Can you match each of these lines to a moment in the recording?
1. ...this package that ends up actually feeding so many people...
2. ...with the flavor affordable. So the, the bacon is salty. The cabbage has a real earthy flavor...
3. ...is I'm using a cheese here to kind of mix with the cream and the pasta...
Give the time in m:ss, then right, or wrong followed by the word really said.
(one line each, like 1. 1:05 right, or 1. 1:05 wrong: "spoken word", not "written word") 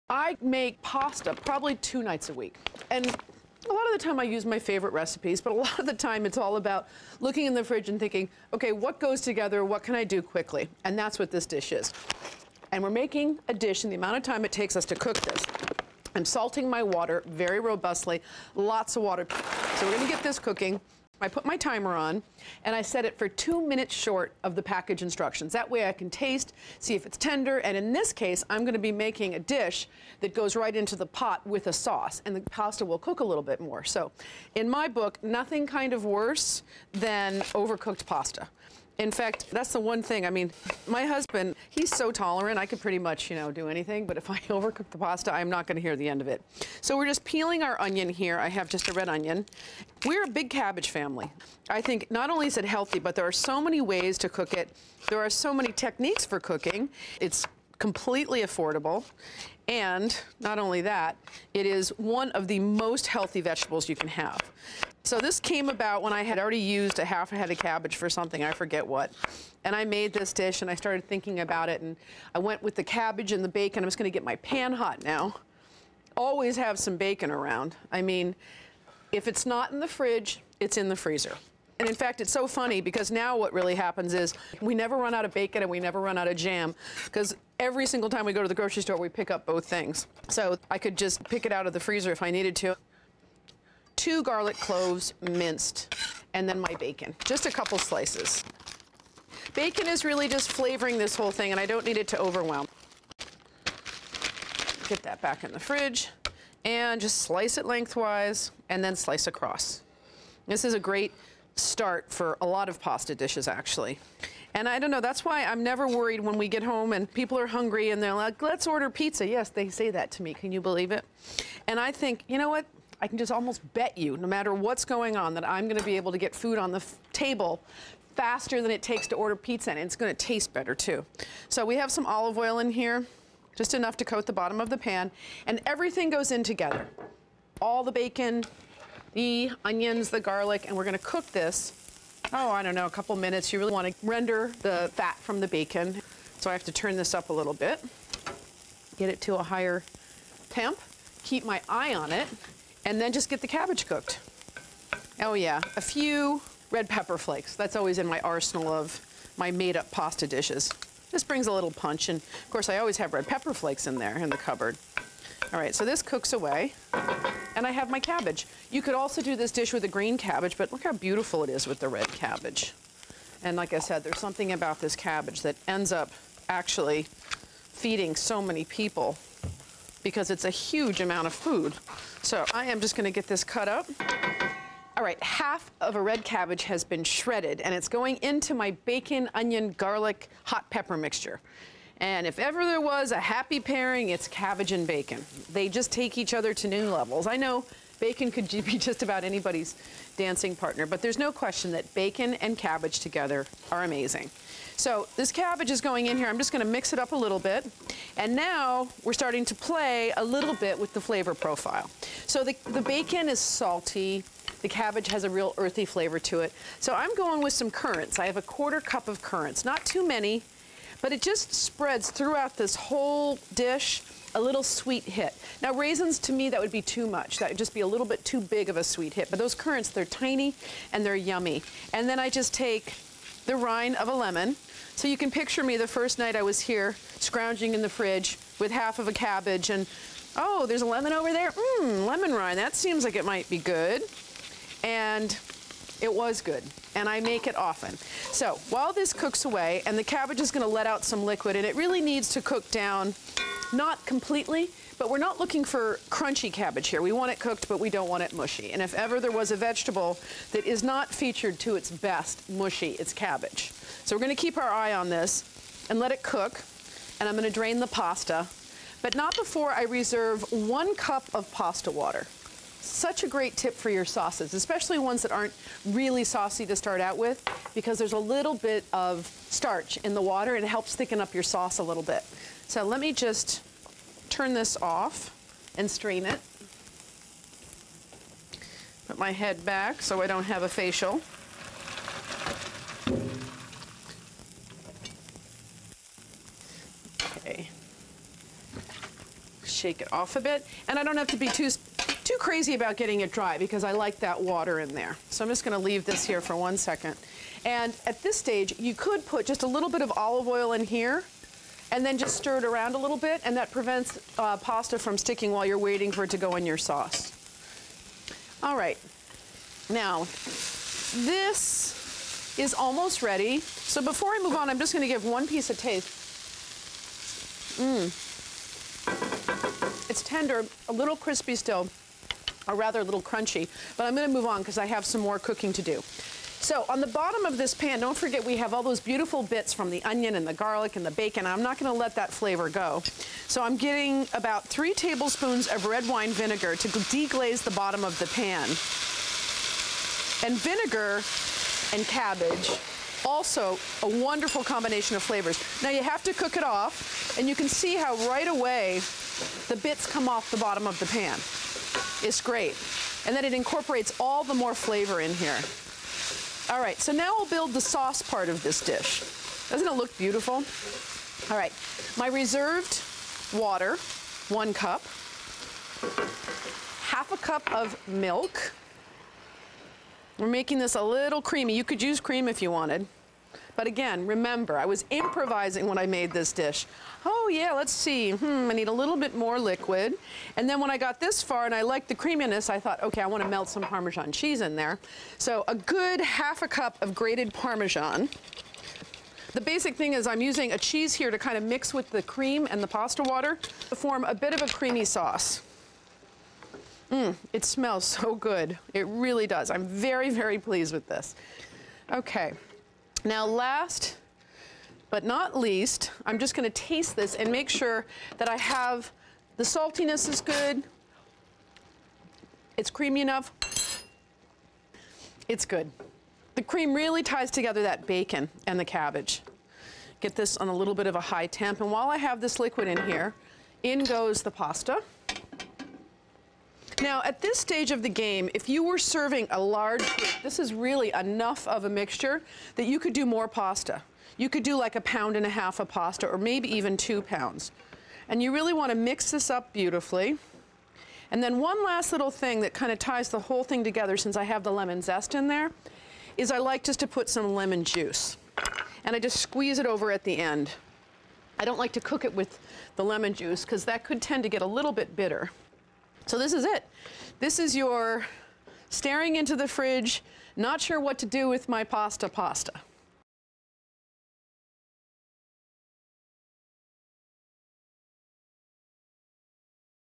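1. 2:54 wrong: "cabbage", not "package"
2. 3:30 wrong: "profile", not "affordable"
3. 6:40 right.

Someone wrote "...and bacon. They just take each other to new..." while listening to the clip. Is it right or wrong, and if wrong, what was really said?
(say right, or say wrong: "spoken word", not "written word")
right.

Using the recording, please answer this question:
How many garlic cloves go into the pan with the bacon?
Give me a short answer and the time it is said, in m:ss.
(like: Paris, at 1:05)
2, at 1:34.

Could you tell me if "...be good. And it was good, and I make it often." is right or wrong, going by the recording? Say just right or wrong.
right.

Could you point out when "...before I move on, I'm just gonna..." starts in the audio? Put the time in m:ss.
5:24.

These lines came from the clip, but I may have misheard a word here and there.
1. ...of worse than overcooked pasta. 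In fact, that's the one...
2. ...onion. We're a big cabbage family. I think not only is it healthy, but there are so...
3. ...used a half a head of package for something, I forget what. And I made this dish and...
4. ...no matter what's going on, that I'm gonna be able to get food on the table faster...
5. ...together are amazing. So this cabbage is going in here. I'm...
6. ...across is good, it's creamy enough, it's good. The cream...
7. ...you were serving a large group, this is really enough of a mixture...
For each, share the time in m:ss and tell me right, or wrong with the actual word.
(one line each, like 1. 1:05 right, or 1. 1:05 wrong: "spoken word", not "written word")
1. 0:35 right
2. 0:49 right
3. 1:06 wrong: "cabbage", not "package"
4. 2:04 right
5. 3:22 right
6. 6:59 wrong: "saltiness", not "across"
7. 7:18 right.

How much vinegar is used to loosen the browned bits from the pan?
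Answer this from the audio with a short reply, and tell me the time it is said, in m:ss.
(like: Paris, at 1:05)
3 tablespoons, at 5:44.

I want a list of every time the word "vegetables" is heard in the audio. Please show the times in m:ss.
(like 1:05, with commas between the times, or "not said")
1:03, 4:19.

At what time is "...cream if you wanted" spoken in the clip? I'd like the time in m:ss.
6:22.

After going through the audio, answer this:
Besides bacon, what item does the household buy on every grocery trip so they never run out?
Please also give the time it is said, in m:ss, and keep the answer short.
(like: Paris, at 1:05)
jam, at 1:26.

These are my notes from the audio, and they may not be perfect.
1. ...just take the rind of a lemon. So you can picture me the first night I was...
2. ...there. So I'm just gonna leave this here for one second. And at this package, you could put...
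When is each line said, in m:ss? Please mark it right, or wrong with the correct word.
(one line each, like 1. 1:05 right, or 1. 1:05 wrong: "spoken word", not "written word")
1. 3:52 right
2. 5:04 wrong: "stage", not "package".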